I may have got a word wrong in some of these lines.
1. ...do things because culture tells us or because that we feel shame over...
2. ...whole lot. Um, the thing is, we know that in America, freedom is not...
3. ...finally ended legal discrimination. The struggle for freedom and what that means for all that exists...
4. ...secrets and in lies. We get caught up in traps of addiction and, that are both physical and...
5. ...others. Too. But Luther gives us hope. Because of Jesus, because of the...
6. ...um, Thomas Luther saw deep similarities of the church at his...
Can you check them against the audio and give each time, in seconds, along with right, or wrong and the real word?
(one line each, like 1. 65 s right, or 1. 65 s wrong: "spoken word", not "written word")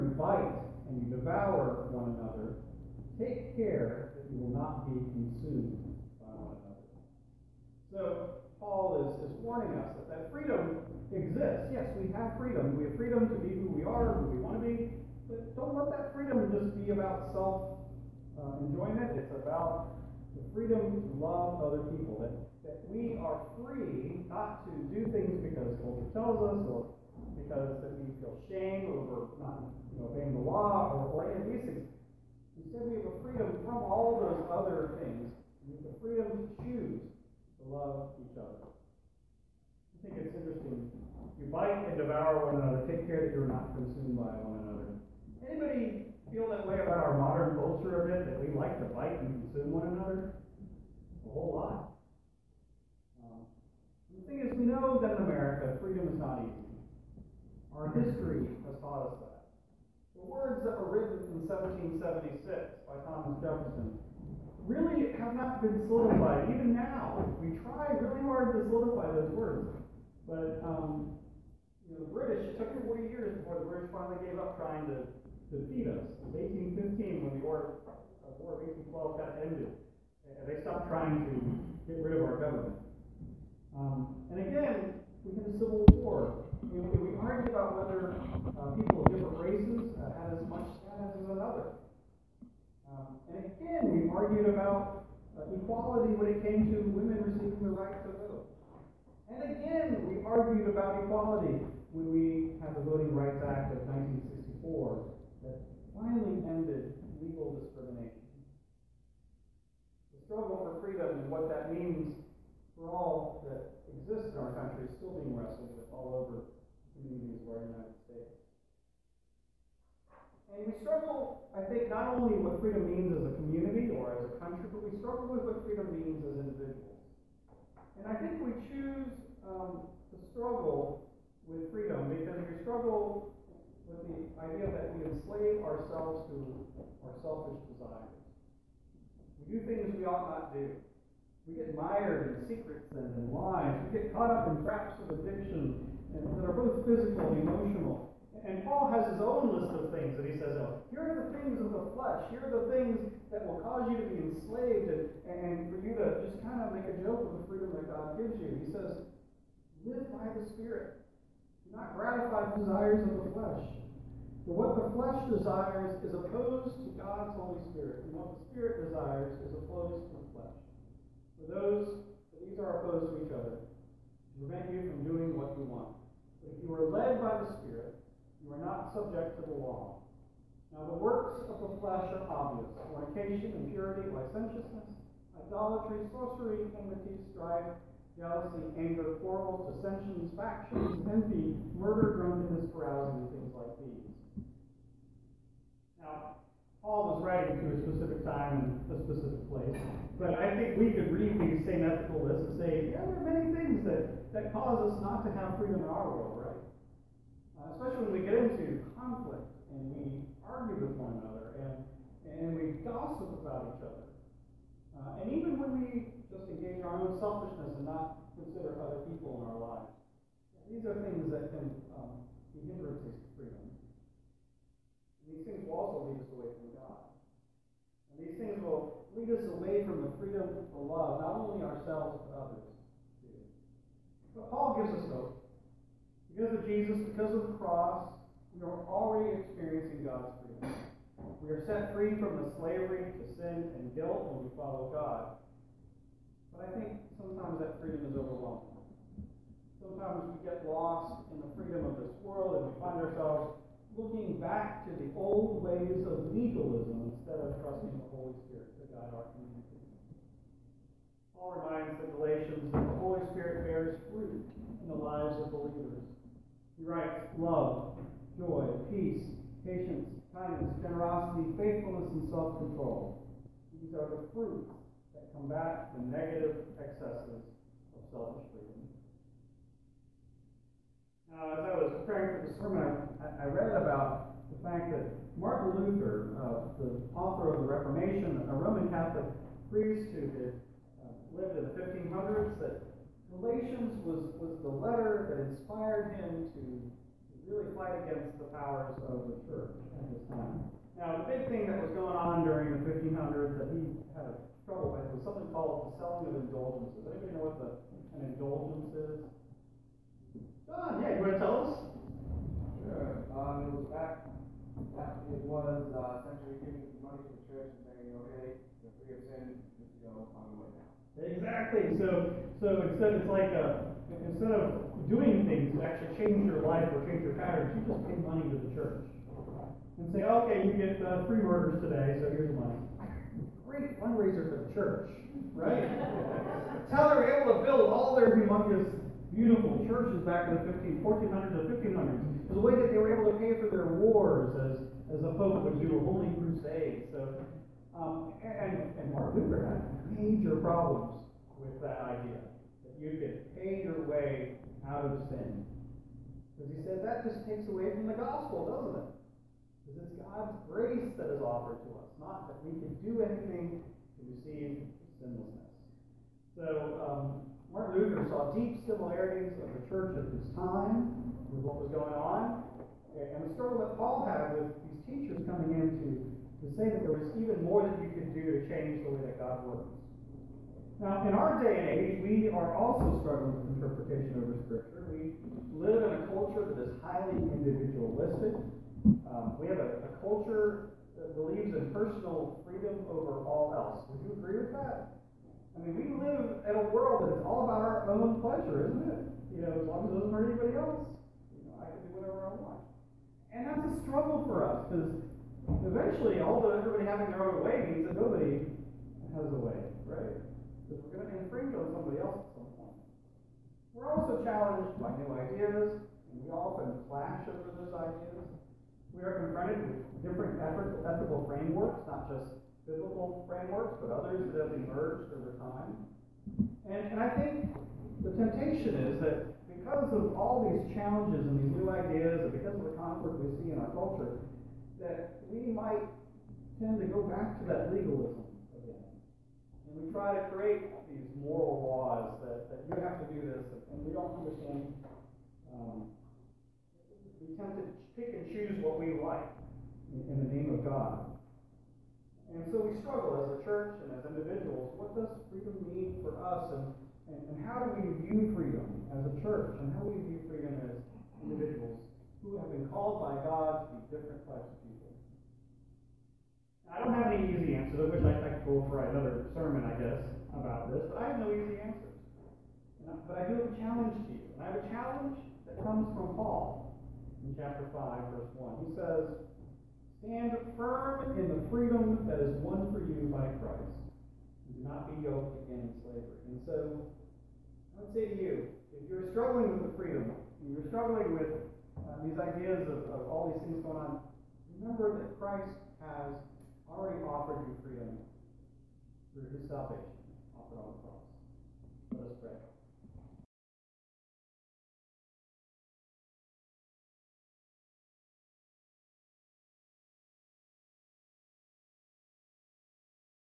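1. 24 s right
2. 51 s right
3. 105 s right
4. 142 s right
5. 232 s wrong: "Paul", not "Luther"
6. 366 s wrong: "Martin", not "Thomas".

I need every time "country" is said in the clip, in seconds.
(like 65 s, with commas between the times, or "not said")
114 s, 124 s.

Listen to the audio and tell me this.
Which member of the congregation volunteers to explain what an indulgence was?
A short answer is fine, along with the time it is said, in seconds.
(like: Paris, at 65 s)
John, at 310 s.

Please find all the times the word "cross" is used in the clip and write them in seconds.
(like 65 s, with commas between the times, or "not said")
237 s, 501 s.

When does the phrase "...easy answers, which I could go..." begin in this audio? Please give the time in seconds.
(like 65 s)
467 s.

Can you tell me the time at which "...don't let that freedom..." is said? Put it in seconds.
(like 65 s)
15 s.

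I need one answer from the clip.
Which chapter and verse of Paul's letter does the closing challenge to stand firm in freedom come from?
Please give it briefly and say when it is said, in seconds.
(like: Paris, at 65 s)
chapter 5, verse 1, at 477 s.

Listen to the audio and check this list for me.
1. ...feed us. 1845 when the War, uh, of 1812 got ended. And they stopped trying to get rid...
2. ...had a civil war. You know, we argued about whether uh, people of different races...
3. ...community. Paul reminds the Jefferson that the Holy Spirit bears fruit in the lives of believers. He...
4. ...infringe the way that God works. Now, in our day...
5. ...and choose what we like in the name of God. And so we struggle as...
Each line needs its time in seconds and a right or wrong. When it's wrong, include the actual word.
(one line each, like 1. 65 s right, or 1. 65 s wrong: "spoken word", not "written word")
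1. 75 s wrong: "1815", not "1845"
2. 85 s right
3. 259 s wrong: "Galatians", not "Jefferson"
4. 378 s wrong: "change", not "infringe"
5. 448 s right.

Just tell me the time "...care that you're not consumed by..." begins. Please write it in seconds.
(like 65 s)
43 s.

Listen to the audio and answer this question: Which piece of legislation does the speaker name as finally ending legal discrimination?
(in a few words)
Voting Rights Act of 1964.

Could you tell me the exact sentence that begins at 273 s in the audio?
These are the fruits that combat the negative excesses of selfish freedom.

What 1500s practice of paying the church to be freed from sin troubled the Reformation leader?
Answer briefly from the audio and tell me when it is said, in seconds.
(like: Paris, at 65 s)
selling of indulgences, at 306 s.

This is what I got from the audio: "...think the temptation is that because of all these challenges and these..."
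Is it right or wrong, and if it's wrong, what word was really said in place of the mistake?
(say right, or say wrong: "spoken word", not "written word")
right.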